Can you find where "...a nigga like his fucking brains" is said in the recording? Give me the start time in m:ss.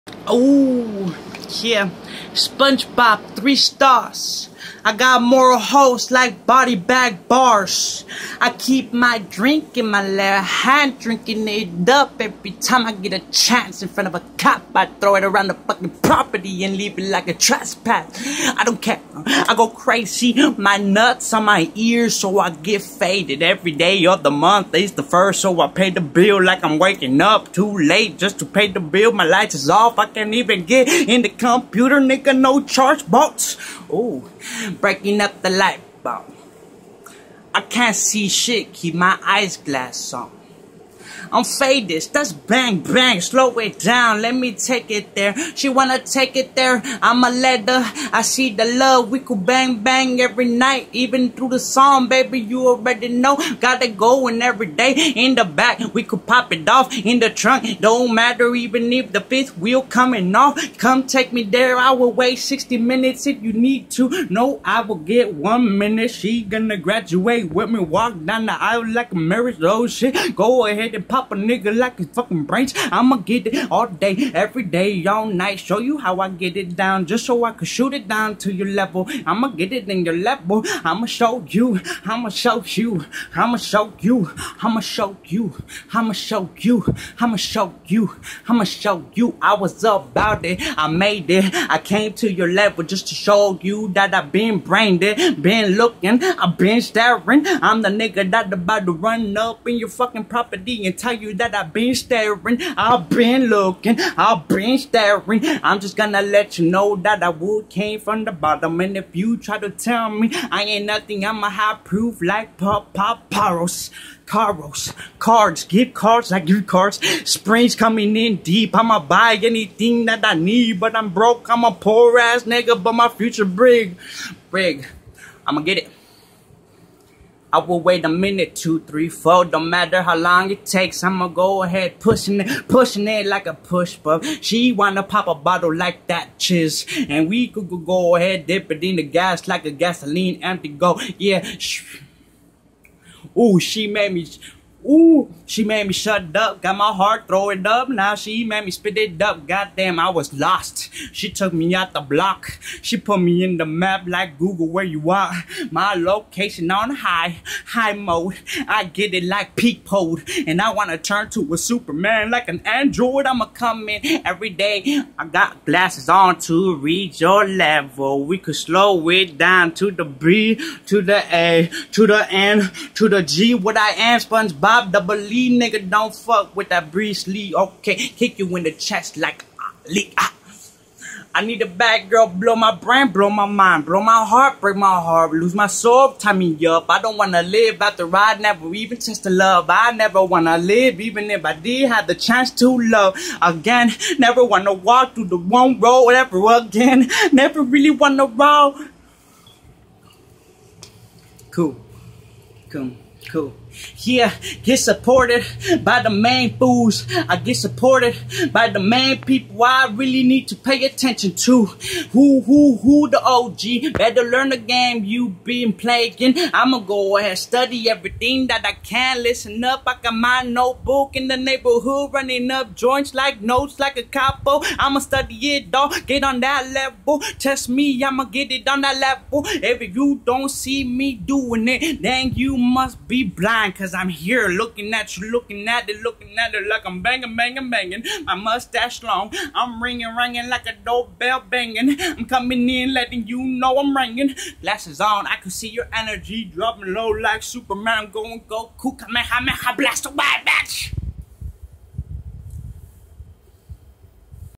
1:11.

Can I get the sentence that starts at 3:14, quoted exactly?
Never wanna walk through the wrong road ever again.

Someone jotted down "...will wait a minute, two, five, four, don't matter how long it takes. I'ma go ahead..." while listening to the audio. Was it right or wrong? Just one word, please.
wrong.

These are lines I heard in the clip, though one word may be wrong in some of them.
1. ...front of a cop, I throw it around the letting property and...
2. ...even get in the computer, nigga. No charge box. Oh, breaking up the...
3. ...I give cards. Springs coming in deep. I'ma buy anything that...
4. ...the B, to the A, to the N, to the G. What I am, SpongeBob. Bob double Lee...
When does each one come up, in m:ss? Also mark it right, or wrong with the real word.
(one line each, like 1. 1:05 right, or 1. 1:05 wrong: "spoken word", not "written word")
1. 0:13 wrong: "fucking", not "letting"
2. 0:30 right
3. 1:56 right
4. 2:49 right.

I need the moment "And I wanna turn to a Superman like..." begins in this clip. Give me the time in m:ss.
2:40.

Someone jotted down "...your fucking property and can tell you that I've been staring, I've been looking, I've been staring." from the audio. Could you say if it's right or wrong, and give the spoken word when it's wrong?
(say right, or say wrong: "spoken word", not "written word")
right.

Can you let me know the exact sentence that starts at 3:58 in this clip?
My mustache long, I'm ringing, ringing like a doorbell banging.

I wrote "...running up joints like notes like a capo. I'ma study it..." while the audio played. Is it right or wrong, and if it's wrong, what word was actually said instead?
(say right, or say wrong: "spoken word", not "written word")
right.